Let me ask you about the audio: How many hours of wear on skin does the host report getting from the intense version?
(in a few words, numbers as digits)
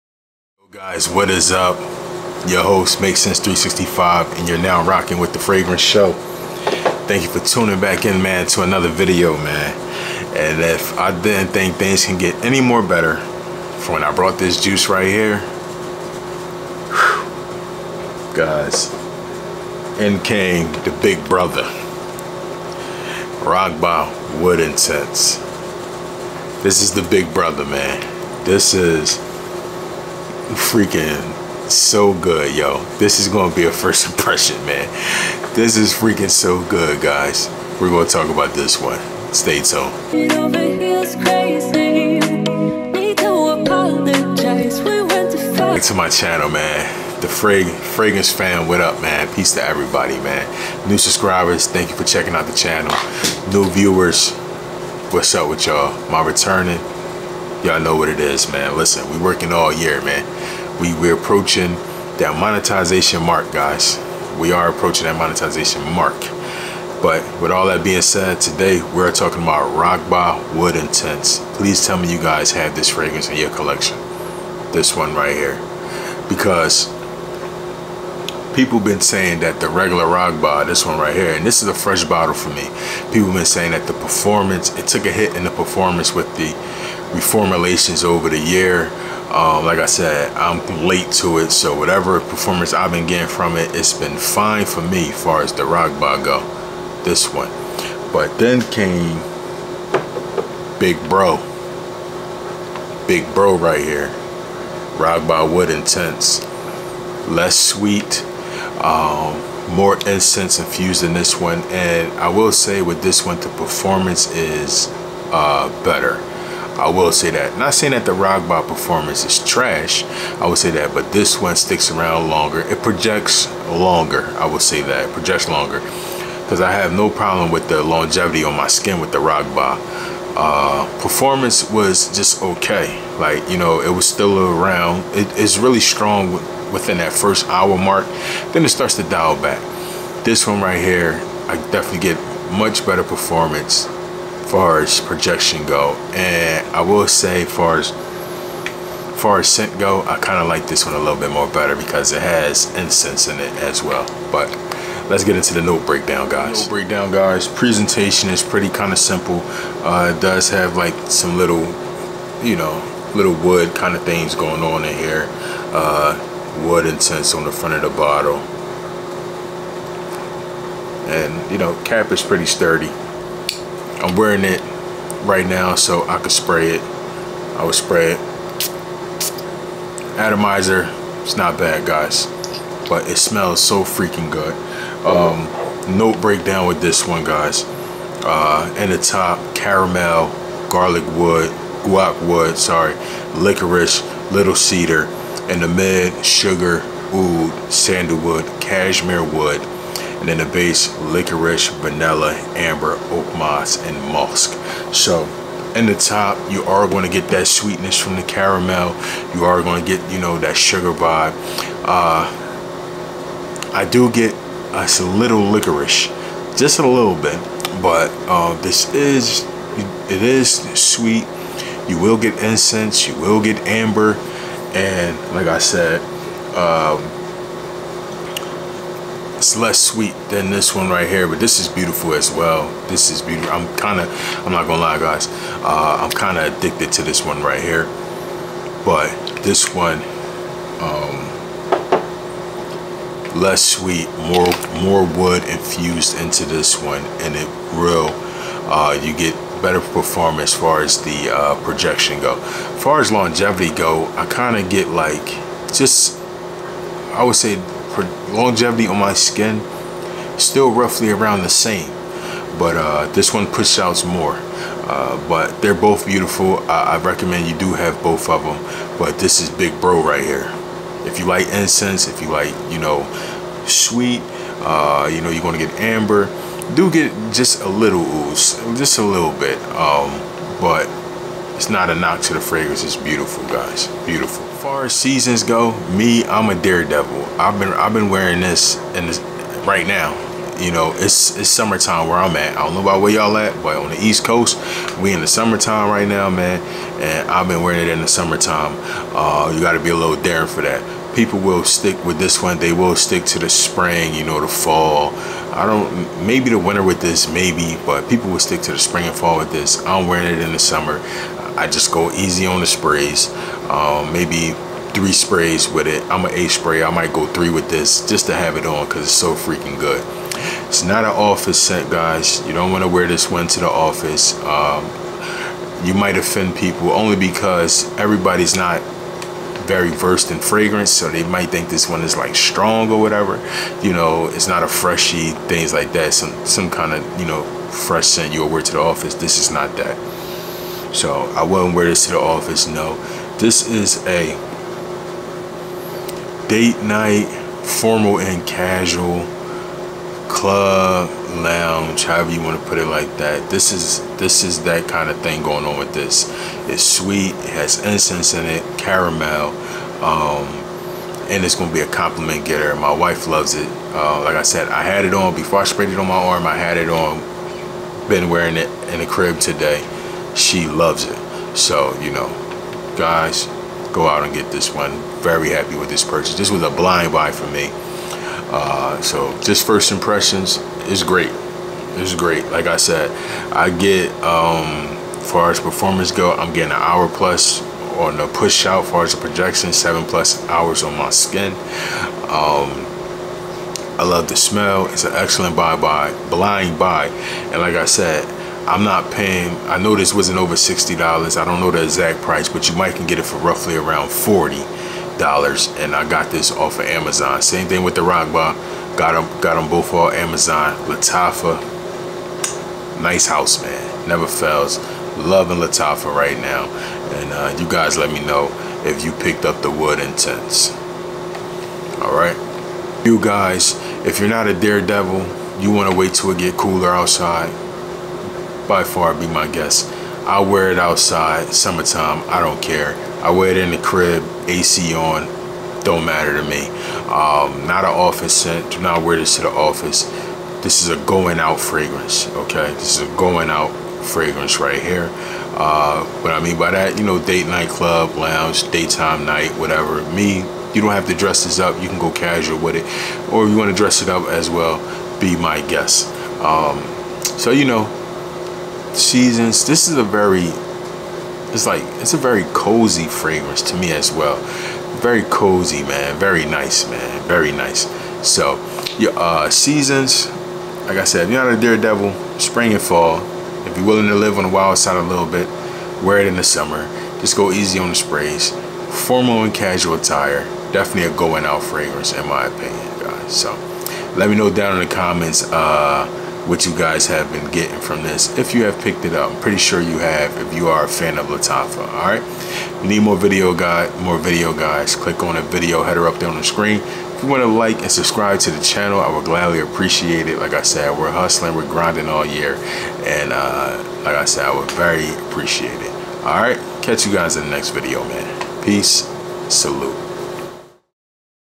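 7 hours.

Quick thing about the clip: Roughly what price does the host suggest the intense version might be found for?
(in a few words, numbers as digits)
$40.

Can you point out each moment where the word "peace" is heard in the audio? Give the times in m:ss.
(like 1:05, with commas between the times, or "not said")
0:49, 8:28.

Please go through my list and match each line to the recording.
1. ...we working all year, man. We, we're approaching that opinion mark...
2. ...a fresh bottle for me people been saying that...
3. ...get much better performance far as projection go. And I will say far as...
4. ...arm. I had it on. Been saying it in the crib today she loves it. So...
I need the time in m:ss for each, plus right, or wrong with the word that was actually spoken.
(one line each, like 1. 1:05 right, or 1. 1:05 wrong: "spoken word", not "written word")
1. 0:59 wrong: "monetization", not "opinion"
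2. 1:21 right
3. 2:21 right
4. 6:06 wrong: "wearing", not "saying".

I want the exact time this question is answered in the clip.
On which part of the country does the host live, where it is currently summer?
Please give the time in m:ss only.
4:54.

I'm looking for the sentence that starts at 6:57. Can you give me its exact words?
And uh, you guys let me know if you picked up the wood intense.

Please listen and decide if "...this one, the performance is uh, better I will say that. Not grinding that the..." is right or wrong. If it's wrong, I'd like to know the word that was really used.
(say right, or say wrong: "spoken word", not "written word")
wrong: "saying", not "grinding".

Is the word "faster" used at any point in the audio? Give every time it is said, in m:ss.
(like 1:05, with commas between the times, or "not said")
not said.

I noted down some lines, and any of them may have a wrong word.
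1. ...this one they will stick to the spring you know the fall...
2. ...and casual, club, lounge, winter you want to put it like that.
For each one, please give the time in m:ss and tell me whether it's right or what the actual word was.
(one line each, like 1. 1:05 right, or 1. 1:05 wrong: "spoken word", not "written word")
1. 5:02 right
2. 5:48 wrong: "however", not "winter".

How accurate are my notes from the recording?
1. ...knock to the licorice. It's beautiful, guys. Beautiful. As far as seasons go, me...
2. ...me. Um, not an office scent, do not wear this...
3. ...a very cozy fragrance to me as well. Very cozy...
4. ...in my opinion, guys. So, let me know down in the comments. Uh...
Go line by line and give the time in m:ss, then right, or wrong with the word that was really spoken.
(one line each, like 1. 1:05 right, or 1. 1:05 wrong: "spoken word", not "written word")
1. 4:41 wrong: "fragrance", not "licorice"
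2. 7:16 right
3. 7:42 right
4. 8:02 right.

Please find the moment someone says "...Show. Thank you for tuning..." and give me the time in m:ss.
0:05.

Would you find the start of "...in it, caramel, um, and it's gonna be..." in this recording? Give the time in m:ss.
5:58.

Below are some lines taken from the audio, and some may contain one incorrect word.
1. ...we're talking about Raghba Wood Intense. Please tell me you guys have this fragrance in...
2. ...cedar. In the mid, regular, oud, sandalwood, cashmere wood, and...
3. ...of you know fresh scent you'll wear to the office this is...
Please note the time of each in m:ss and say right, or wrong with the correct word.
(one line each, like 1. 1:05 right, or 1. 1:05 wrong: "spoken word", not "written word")
1. 1:08 right
2. 3:14 wrong: "sugar", not "regular"
3. 5:36 right.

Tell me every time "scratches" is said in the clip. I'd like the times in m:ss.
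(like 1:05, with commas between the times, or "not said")
not said.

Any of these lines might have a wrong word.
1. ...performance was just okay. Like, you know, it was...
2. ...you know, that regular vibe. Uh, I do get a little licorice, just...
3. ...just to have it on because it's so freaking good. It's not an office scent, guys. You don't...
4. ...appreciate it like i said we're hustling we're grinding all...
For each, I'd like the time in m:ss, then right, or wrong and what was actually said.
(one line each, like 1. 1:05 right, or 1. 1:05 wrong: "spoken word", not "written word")
1. 2:11 right
2. 3:30 wrong: "sugar", not "regular"
3. 5:18 right
4. 8:19 right.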